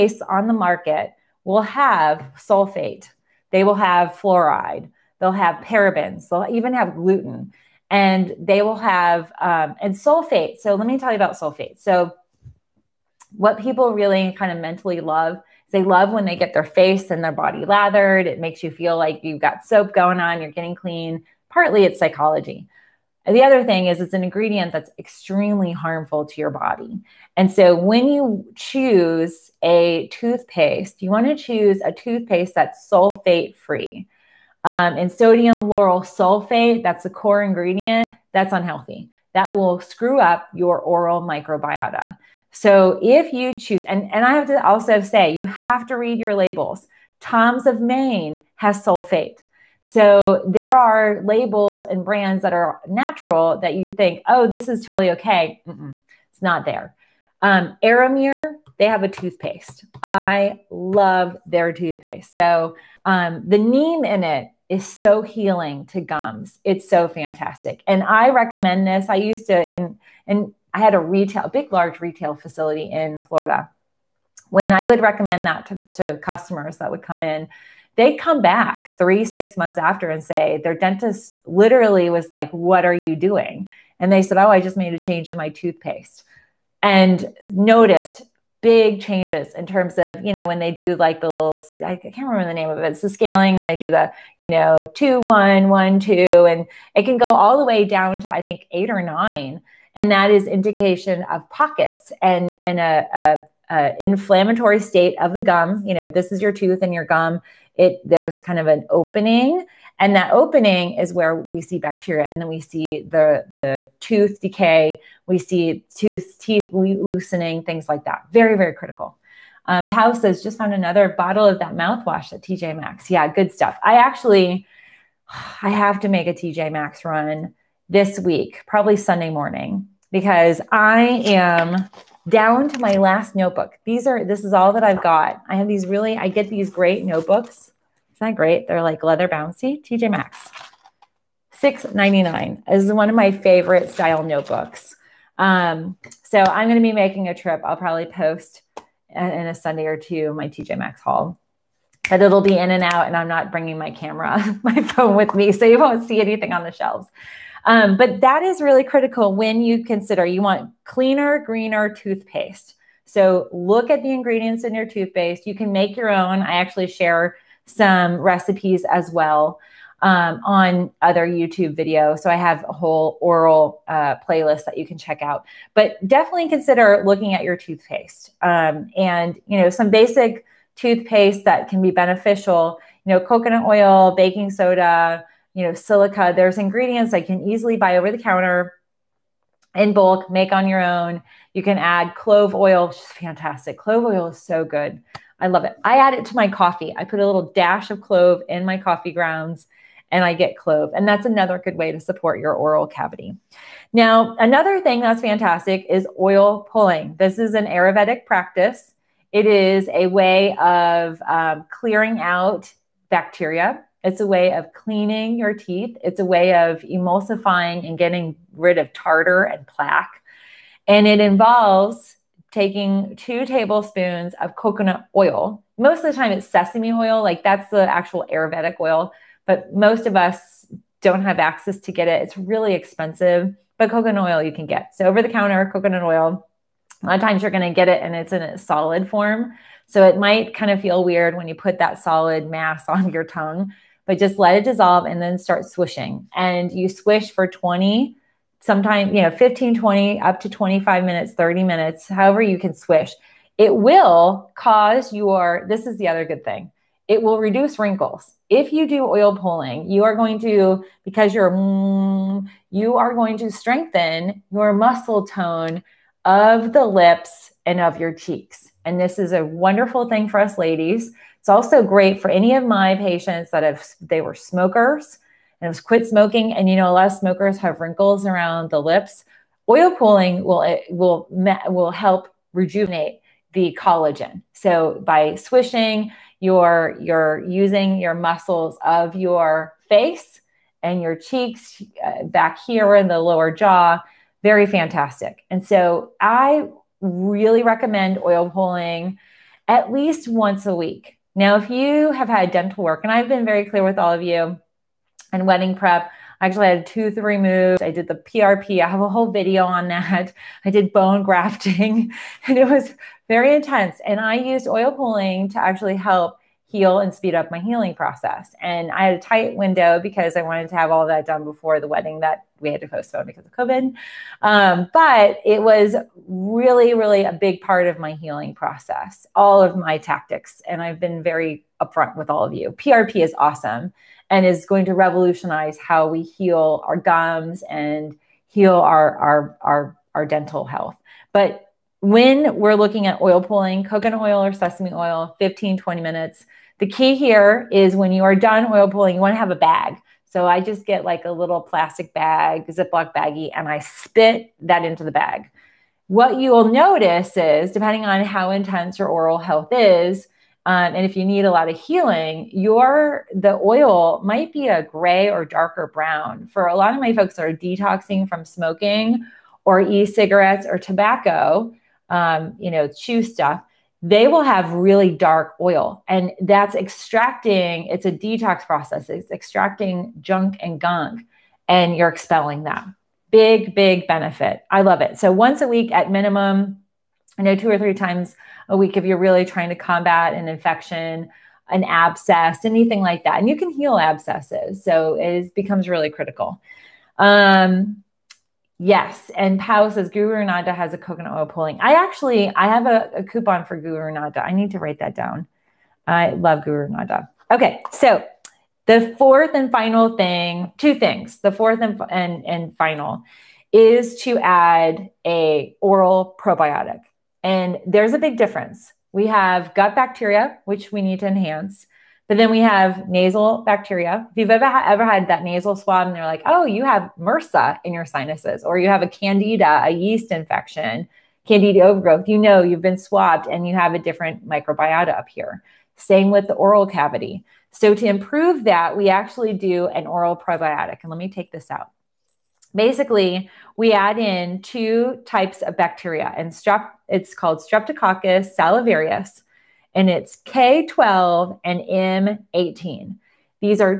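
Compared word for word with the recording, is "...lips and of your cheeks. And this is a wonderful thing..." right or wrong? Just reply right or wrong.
right.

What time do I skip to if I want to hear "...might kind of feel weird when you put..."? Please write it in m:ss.
4:00.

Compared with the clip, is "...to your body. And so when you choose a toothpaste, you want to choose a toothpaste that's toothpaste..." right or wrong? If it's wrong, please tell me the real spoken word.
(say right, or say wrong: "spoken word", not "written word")
wrong: "sulfate", not "toothpaste".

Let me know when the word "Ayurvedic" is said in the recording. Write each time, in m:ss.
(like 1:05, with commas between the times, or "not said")
3:27, 3:48.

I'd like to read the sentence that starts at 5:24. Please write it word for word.
Um, but it was really, really a big part of my healing process, all of my tactics.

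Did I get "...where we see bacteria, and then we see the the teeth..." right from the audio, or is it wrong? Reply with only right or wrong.
wrong.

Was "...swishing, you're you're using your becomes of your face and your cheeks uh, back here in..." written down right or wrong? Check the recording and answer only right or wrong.
wrong.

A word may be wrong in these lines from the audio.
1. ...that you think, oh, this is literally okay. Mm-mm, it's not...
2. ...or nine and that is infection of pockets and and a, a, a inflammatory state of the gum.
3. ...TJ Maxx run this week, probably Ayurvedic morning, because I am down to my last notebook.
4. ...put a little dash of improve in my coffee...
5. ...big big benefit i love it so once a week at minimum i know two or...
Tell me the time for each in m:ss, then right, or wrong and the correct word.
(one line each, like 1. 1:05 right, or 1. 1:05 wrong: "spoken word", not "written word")
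1. 0:53 wrong: "totally", not "literally"
2. 1:38 wrong: "indication", not "infection"
3. 2:06 wrong: "Sunday", not "Ayurvedic"
4. 3:17 wrong: "clove", not "improve"
5. 6:23 right.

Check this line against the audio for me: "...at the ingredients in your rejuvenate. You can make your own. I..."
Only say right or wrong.
wrong.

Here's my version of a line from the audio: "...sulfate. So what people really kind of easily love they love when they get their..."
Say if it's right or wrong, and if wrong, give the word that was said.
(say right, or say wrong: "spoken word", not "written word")
wrong: "mentally", not "easily".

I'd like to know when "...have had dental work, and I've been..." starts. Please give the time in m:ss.
5:02.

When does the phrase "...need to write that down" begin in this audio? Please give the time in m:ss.
6:44.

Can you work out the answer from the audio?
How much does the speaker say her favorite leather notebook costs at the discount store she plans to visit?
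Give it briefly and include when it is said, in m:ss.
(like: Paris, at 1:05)
$6.99, at 2:21.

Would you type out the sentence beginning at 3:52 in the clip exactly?
It's really expensive, but coconut oil you can get.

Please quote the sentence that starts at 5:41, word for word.
But when we're looking at oil pulling, coconut oil or sesame oil, 15, 20 minutes.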